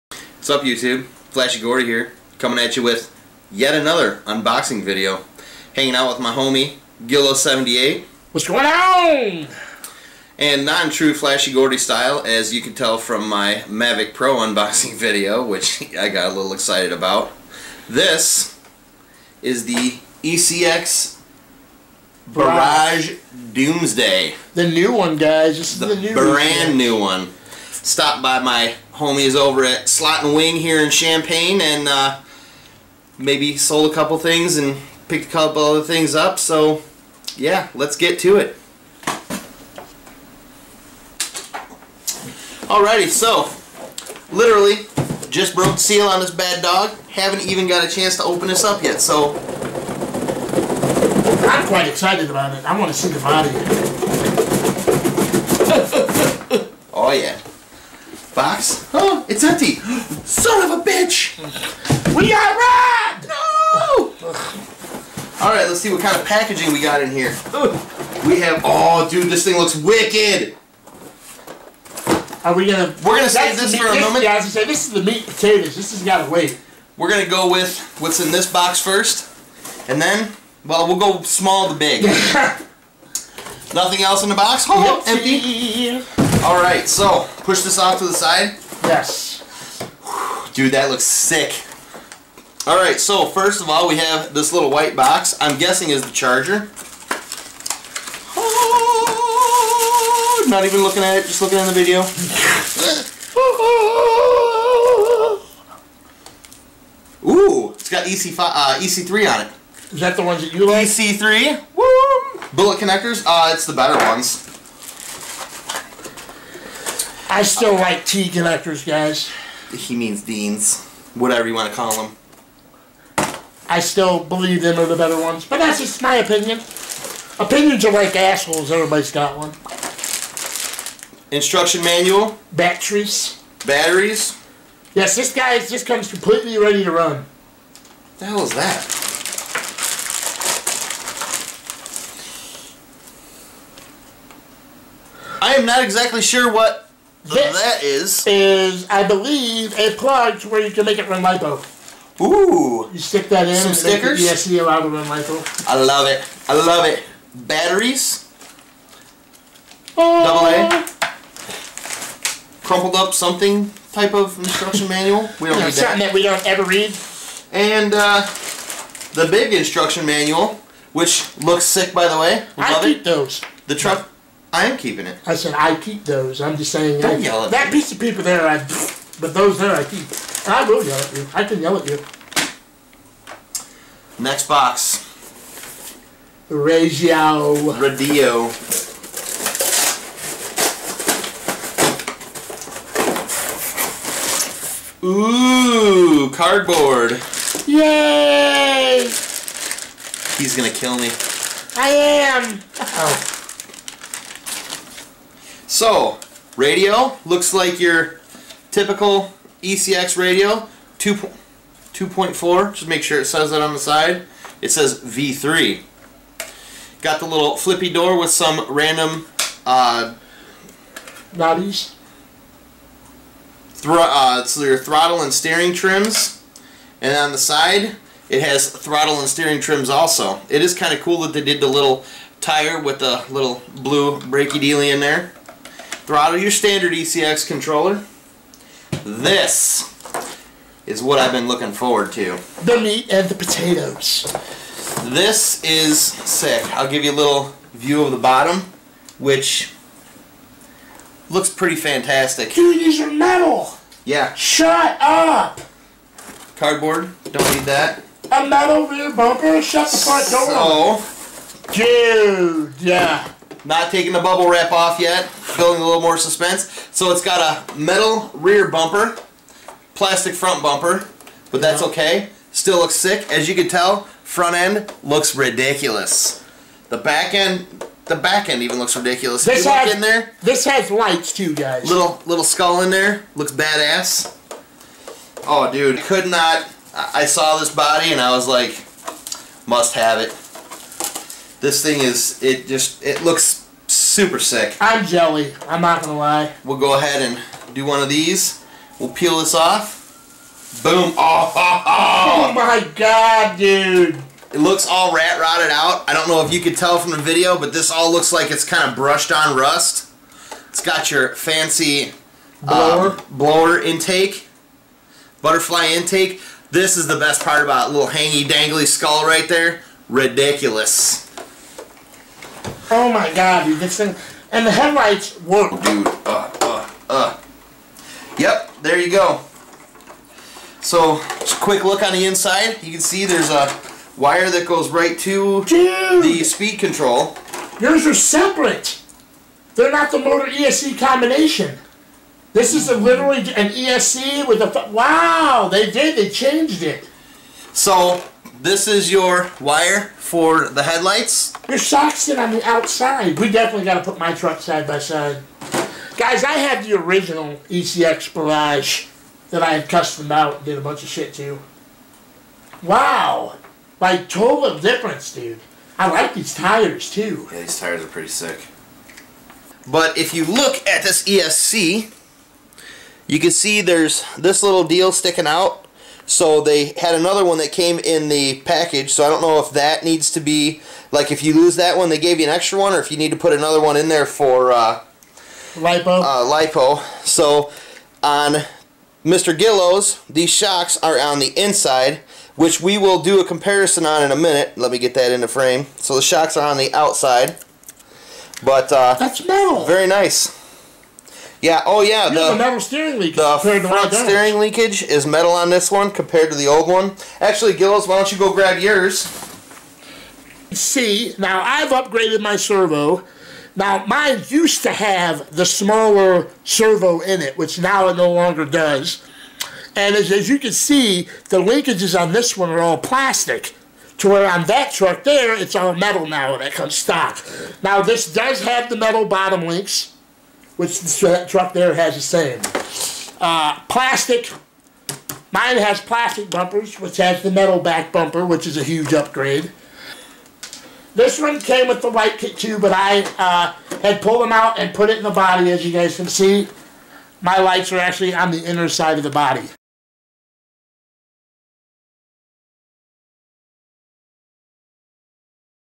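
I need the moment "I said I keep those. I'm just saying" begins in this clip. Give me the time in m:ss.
2:55.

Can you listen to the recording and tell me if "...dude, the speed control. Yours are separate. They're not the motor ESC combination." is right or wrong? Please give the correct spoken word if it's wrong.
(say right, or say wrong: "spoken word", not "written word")
right.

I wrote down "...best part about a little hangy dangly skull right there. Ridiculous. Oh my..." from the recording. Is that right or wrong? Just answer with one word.
right.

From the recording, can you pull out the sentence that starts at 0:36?
So yeah, let's get to it.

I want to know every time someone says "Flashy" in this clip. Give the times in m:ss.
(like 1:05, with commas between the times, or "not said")
0:01, 0:11.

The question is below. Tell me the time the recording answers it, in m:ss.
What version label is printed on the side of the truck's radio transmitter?
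3:34.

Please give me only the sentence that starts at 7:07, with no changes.
Now, this does have the metal bottom links which that truck there has the same.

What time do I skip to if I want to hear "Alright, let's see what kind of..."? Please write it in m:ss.
1:05.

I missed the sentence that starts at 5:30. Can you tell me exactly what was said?
So, just quick look on the inside.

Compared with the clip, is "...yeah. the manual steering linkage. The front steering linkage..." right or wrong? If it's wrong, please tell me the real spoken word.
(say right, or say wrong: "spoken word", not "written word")
wrong: "metal", not "manual".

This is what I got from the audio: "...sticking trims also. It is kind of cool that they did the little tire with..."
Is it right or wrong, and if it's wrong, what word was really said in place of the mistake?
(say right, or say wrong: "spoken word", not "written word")
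wrong: "steering", not "sticking".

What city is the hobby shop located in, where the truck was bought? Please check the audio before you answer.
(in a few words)
Champaign.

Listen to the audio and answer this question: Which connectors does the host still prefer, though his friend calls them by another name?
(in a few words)
T connectors.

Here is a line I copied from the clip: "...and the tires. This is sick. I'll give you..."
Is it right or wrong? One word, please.
wrong.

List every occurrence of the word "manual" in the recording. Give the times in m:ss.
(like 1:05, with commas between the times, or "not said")
2:11, 2:44, 2:50.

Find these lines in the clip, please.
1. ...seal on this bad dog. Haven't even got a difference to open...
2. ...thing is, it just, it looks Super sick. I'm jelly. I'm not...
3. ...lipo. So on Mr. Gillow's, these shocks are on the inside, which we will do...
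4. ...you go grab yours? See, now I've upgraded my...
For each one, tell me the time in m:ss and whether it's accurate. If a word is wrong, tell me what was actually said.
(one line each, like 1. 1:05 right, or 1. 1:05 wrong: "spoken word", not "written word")
1. 0:45 wrong: "chance", not "difference"
2. 4:51 right
3. 6:26 right
4. 6:48 right.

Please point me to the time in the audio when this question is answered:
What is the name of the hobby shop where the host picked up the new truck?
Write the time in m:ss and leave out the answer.
0:29.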